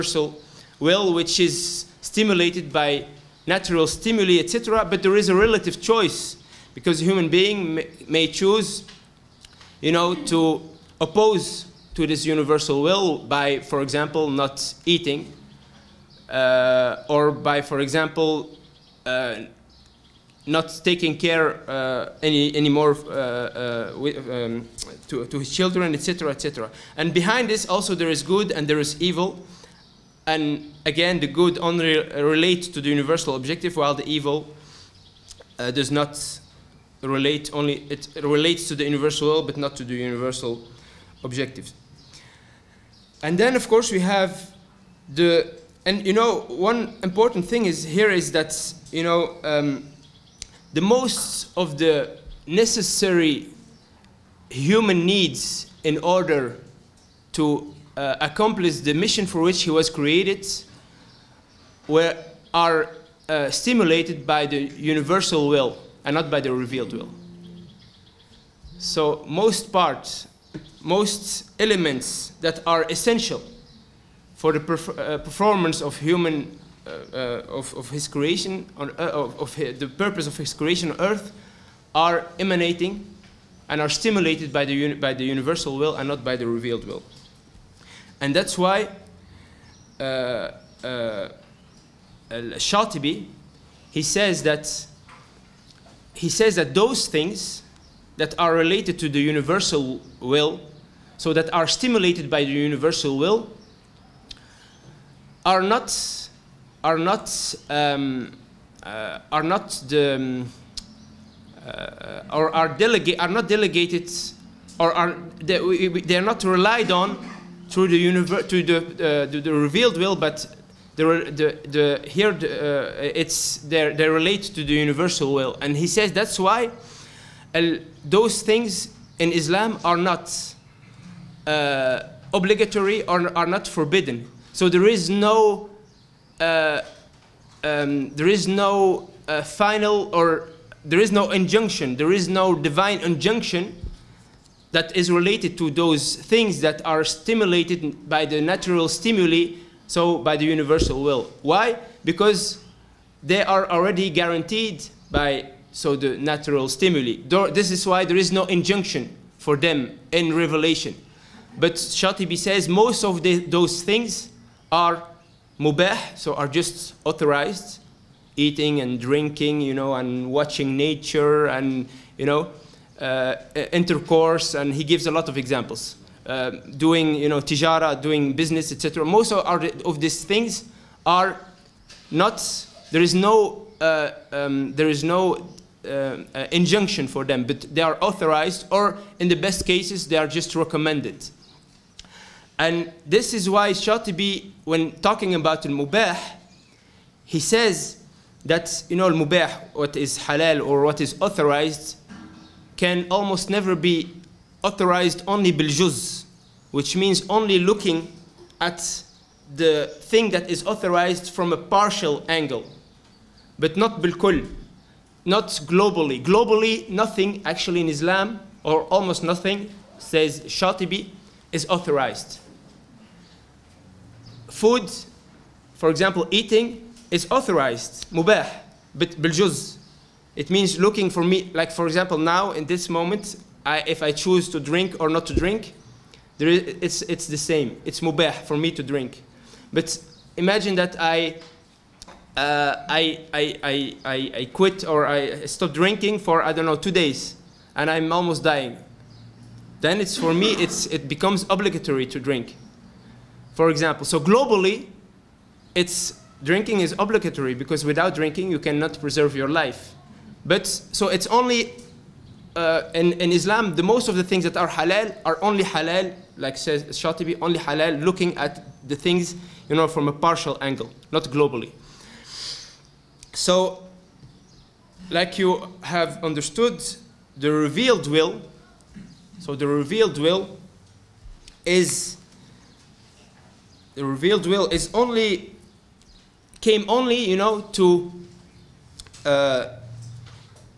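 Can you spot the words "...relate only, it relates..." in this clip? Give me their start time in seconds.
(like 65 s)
37 s.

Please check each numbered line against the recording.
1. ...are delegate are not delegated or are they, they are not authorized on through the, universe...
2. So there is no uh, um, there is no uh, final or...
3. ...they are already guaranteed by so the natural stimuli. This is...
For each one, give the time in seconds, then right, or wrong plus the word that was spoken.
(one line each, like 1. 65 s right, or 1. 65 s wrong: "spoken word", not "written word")
1. 112 s wrong: "relied", not "authorized"
2. 134 s right
3. 153 s right.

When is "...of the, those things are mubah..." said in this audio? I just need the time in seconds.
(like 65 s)
163 s.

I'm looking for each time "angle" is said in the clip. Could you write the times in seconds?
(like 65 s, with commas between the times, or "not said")
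212 s, 270 s.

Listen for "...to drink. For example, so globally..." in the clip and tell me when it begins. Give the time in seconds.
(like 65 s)
252 s.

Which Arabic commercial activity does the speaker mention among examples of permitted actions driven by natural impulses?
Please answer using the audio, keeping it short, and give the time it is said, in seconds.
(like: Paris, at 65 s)
tijara, at 177 s.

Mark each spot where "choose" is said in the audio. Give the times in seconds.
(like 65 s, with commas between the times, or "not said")
8 s, 234 s.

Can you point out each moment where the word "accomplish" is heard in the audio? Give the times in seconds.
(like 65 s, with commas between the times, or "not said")
58 s.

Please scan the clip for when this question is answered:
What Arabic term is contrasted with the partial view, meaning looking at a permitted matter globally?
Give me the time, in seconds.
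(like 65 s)
214 s.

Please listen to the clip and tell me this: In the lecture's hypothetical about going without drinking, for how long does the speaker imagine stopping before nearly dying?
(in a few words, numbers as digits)
2 days.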